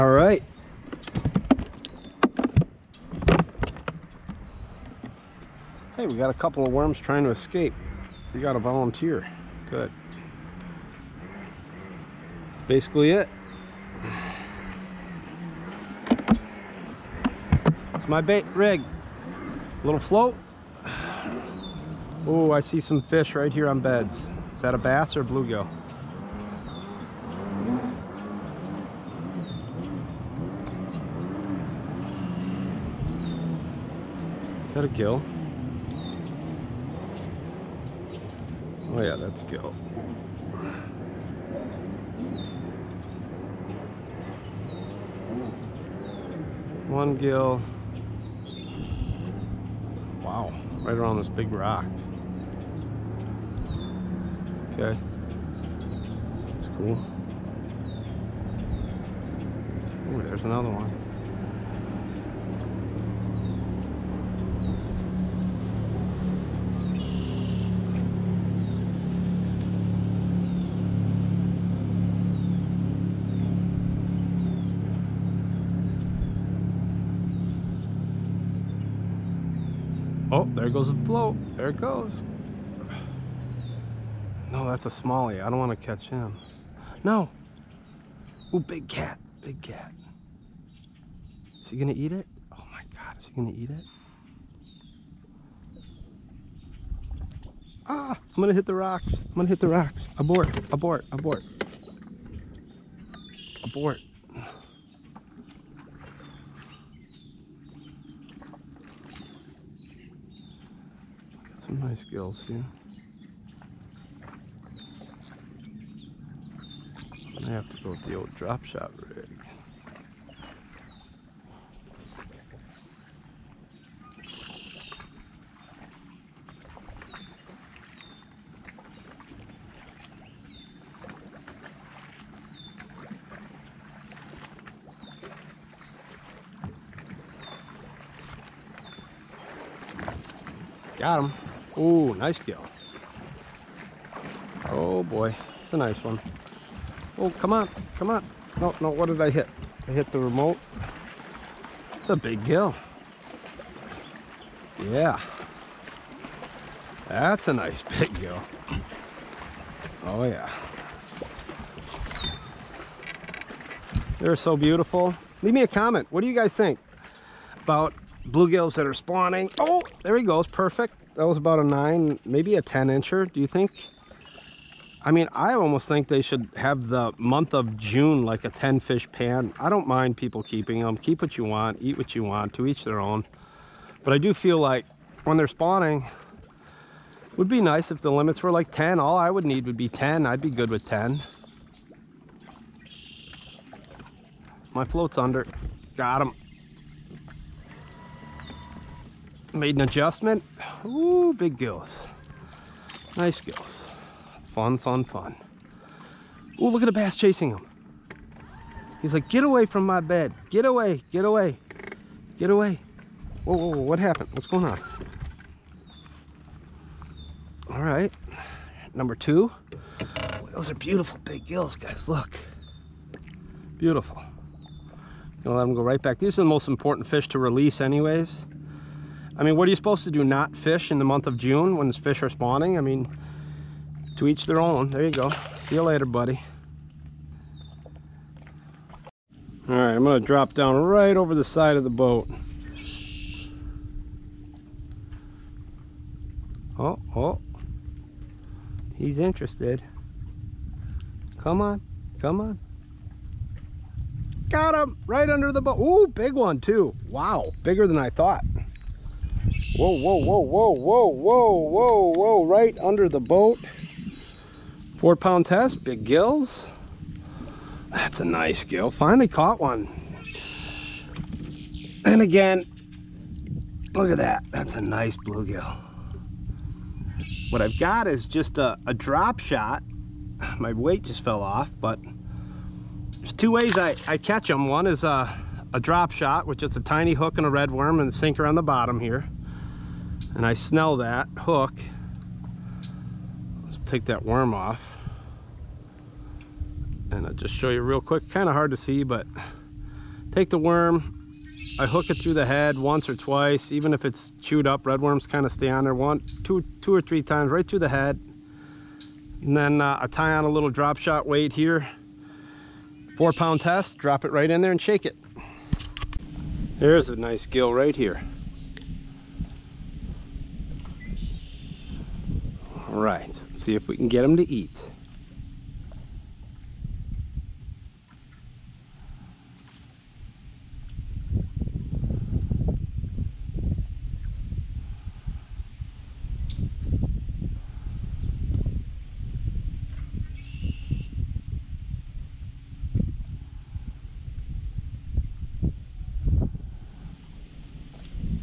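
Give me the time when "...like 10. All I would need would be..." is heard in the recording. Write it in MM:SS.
03:08.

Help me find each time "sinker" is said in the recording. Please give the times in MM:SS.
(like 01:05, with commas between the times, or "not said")
04:48.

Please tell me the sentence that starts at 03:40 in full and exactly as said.
Those are beautiful big gills, guys, look.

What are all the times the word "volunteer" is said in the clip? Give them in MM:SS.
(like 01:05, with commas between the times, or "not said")
00:08.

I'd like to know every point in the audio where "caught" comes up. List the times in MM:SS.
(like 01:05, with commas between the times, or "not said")
04:29.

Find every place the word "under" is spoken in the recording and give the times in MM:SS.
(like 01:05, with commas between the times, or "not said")
03:15, 04:15, 04:22.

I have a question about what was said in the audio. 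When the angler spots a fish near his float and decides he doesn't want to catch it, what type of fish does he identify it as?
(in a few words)
smallie.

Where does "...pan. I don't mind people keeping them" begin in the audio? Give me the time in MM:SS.
02:59.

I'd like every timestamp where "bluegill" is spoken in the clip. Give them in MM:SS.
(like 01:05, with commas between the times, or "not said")
00:25, 02:48, 04:35.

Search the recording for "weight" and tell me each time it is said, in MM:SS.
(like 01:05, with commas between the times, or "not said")
04:40, 05:11.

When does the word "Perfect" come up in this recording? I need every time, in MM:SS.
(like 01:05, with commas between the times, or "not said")
02:50.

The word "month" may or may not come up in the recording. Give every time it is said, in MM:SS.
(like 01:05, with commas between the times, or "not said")
02:57, 03:51.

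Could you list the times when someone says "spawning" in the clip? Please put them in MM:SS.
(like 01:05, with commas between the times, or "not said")
02:48, 03:05, 03:52.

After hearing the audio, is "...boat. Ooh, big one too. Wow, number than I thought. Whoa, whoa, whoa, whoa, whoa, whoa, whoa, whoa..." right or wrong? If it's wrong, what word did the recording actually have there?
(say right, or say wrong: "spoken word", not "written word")
wrong: "bigger", not "number".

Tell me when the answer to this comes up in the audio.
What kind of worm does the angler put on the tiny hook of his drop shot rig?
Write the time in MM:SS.
04:47.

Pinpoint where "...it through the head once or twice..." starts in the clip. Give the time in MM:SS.
05:02.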